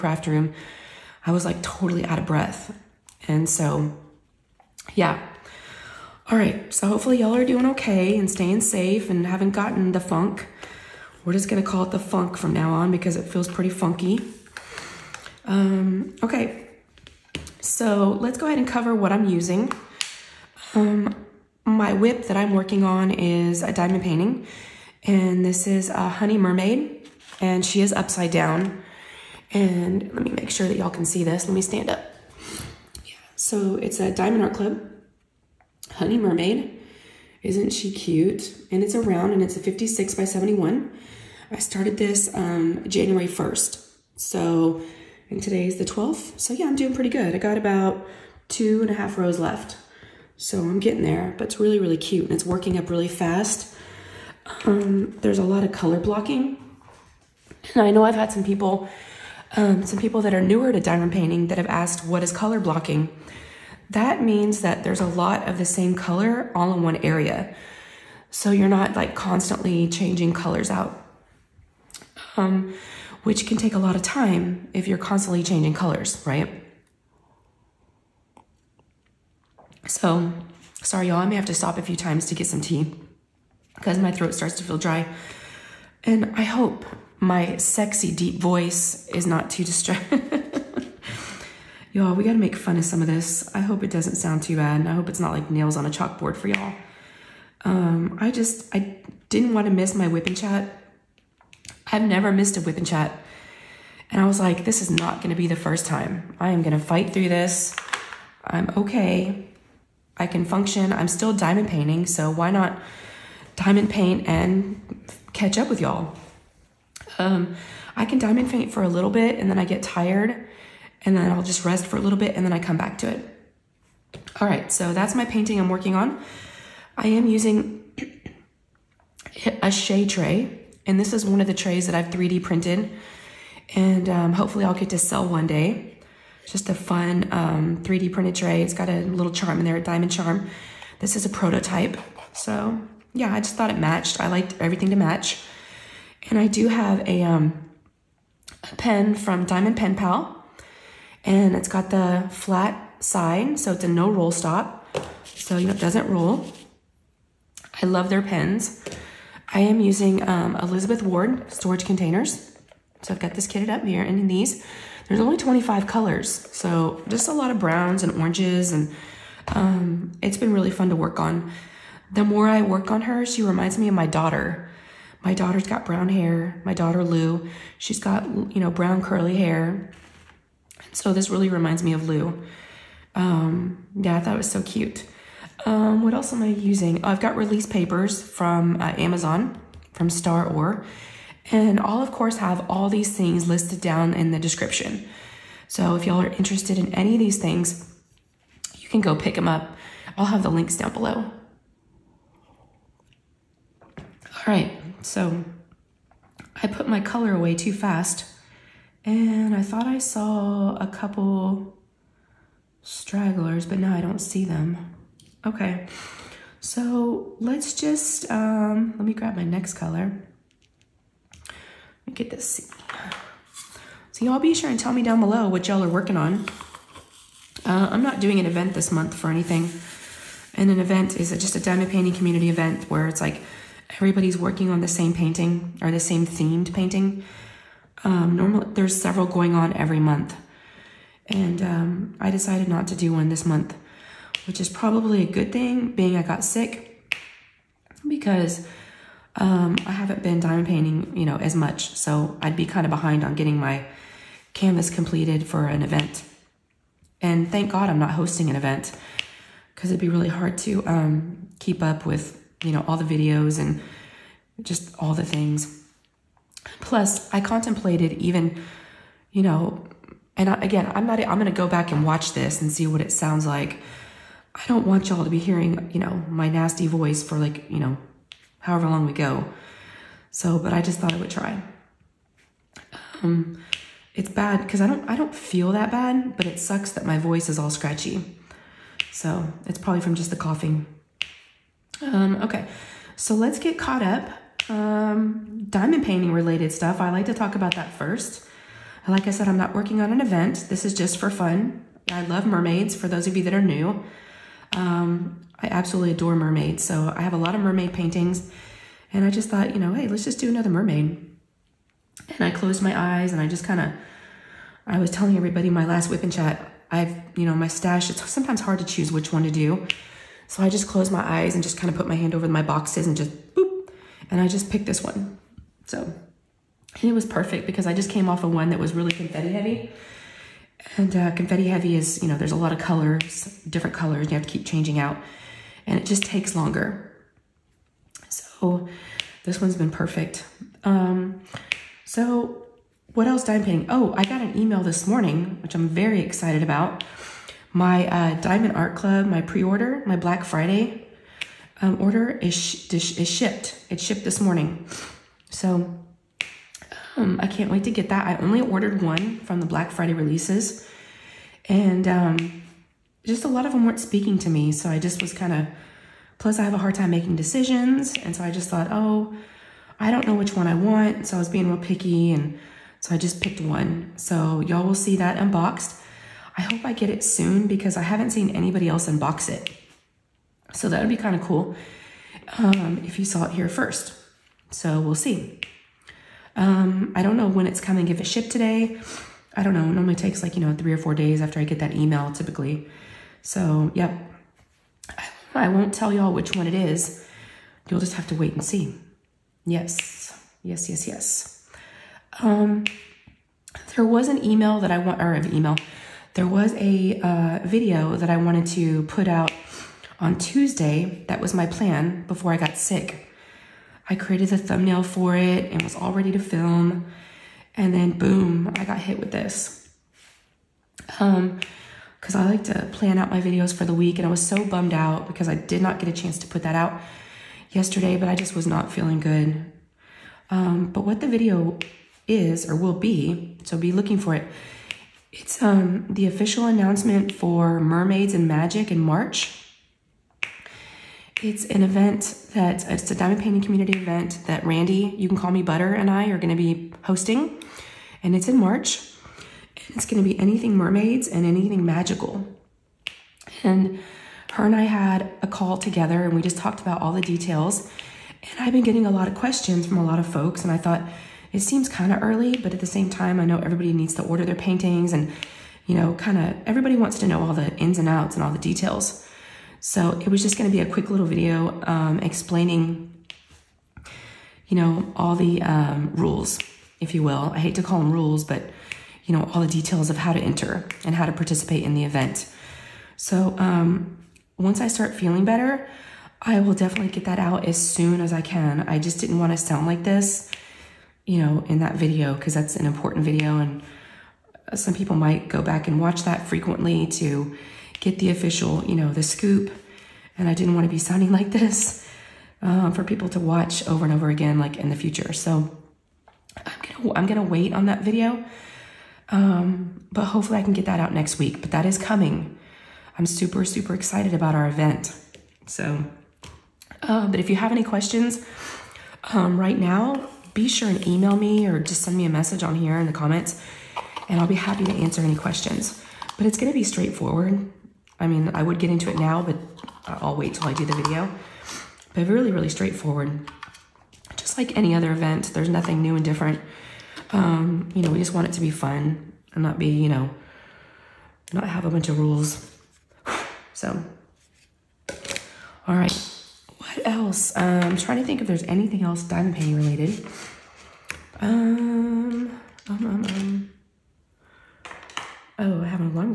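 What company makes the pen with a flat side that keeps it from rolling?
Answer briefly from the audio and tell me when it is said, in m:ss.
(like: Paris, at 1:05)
Diamond Pen Pal, at 2:29.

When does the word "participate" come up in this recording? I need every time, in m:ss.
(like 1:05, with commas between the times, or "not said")
8:01.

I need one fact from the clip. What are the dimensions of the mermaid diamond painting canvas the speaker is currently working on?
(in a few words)
56 by 71.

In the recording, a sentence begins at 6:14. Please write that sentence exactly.
So y'all will see that unboxed.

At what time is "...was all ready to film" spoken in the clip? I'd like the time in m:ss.
6:55.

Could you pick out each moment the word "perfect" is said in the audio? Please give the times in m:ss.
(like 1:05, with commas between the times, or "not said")
5:27, 5:39.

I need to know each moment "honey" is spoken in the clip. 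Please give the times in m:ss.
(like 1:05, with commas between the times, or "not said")
0:26, 0:35.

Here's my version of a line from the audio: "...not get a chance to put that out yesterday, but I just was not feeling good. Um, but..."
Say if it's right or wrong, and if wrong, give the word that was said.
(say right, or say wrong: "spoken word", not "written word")
right.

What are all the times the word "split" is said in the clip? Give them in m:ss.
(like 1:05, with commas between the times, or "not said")
not said.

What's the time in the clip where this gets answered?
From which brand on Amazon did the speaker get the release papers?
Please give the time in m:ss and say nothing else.
3:10.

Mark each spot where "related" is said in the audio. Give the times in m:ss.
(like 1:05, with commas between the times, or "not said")
4:56, 9:09.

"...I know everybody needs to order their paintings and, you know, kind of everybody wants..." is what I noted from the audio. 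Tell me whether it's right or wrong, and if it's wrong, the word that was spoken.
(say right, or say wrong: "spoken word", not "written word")
right.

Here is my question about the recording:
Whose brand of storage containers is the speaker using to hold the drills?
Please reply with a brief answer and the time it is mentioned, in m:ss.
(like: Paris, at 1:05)
Elizabeth Ward, at 2:40.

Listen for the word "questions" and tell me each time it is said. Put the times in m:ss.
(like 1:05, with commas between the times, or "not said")
7:39, 8:37, 8:45.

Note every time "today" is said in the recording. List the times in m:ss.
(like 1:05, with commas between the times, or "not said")
0:45, 6:28.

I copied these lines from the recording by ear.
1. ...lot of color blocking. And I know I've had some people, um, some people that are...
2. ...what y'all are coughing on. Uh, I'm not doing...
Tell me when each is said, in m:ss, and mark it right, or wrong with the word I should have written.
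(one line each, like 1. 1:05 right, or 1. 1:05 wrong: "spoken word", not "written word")
1. 0:55 right
2. 3:45 wrong: "working", not "coughing".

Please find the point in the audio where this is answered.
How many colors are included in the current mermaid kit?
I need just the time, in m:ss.
2:45.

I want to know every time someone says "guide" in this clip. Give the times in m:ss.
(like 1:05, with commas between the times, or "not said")
not said.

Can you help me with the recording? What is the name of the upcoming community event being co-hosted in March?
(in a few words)
Mermaids and Magic.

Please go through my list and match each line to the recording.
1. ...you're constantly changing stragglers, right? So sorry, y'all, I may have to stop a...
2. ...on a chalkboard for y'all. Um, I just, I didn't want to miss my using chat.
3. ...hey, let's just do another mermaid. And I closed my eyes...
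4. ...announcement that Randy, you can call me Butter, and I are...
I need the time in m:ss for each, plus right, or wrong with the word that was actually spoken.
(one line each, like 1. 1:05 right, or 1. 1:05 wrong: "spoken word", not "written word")
1. 1:14 wrong: "colors", not "stragglers"
2. 1:35 wrong: "whipping", not "using"
3. 5:09 right
4. 7:23 wrong: "event", not "announcement".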